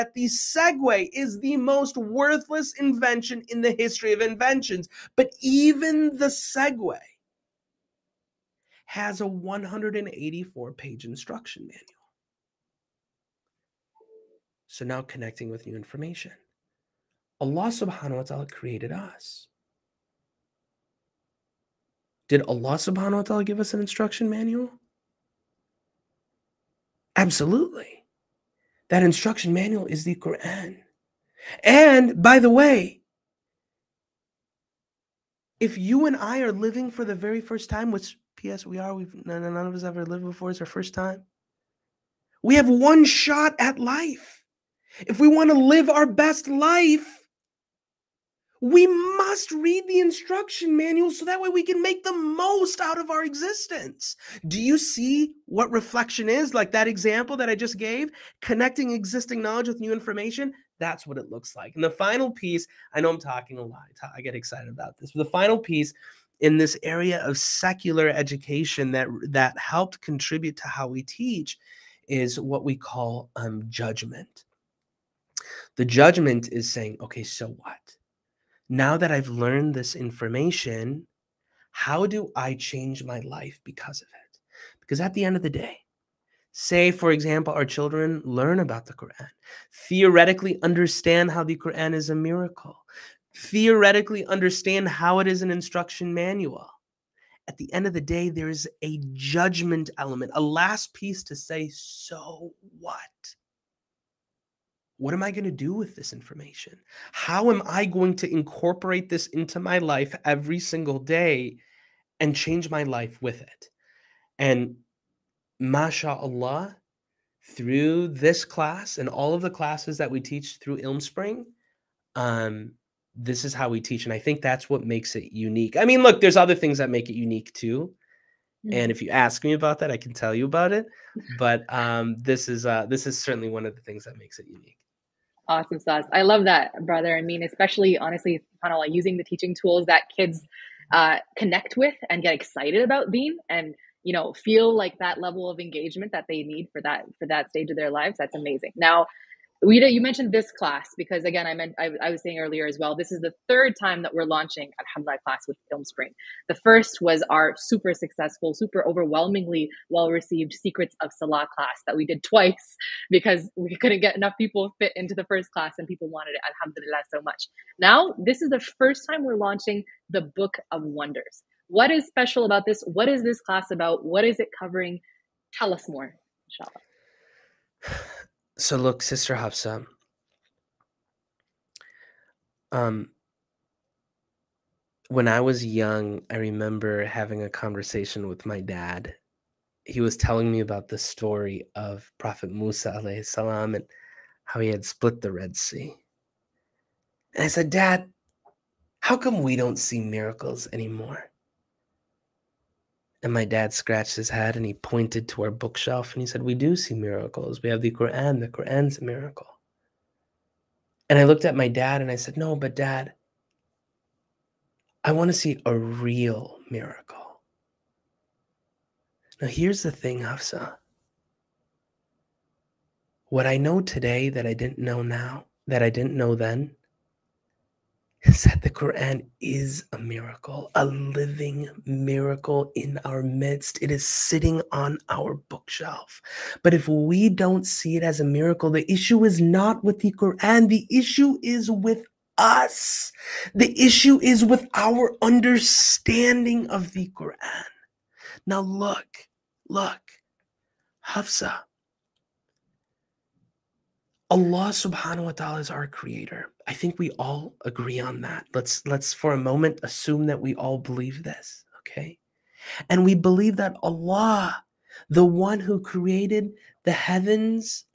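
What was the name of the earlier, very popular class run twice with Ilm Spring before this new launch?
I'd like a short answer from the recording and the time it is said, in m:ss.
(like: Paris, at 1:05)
Secrets of Salah, at 2:40.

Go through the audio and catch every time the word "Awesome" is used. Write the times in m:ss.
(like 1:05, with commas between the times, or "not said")
2:15.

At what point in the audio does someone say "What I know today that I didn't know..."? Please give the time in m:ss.
3:43.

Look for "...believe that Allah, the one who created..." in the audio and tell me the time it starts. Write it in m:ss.
4:23.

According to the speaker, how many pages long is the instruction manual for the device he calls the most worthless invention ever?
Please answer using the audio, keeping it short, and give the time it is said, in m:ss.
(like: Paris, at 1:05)
184, at 0:09.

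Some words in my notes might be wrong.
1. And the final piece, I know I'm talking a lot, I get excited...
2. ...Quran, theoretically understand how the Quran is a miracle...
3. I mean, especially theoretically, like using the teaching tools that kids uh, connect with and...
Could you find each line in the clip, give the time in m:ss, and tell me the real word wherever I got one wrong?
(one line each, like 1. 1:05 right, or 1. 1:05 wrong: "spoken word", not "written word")
1. 1:01 right
2. 1:28 right
3. 2:17 wrong: "honestly", not "theoretically".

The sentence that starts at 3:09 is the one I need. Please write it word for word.
He was telling me about the story of Prophet Musa alayhi salam and how he had split the Red Sea.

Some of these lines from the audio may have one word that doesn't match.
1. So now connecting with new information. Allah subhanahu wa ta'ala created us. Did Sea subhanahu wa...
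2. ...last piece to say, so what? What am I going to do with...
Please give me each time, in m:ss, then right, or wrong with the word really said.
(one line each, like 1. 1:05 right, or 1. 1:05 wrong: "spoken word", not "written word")
1. 0:14 wrong: "Allah", not "Sea"
2. 1:40 right.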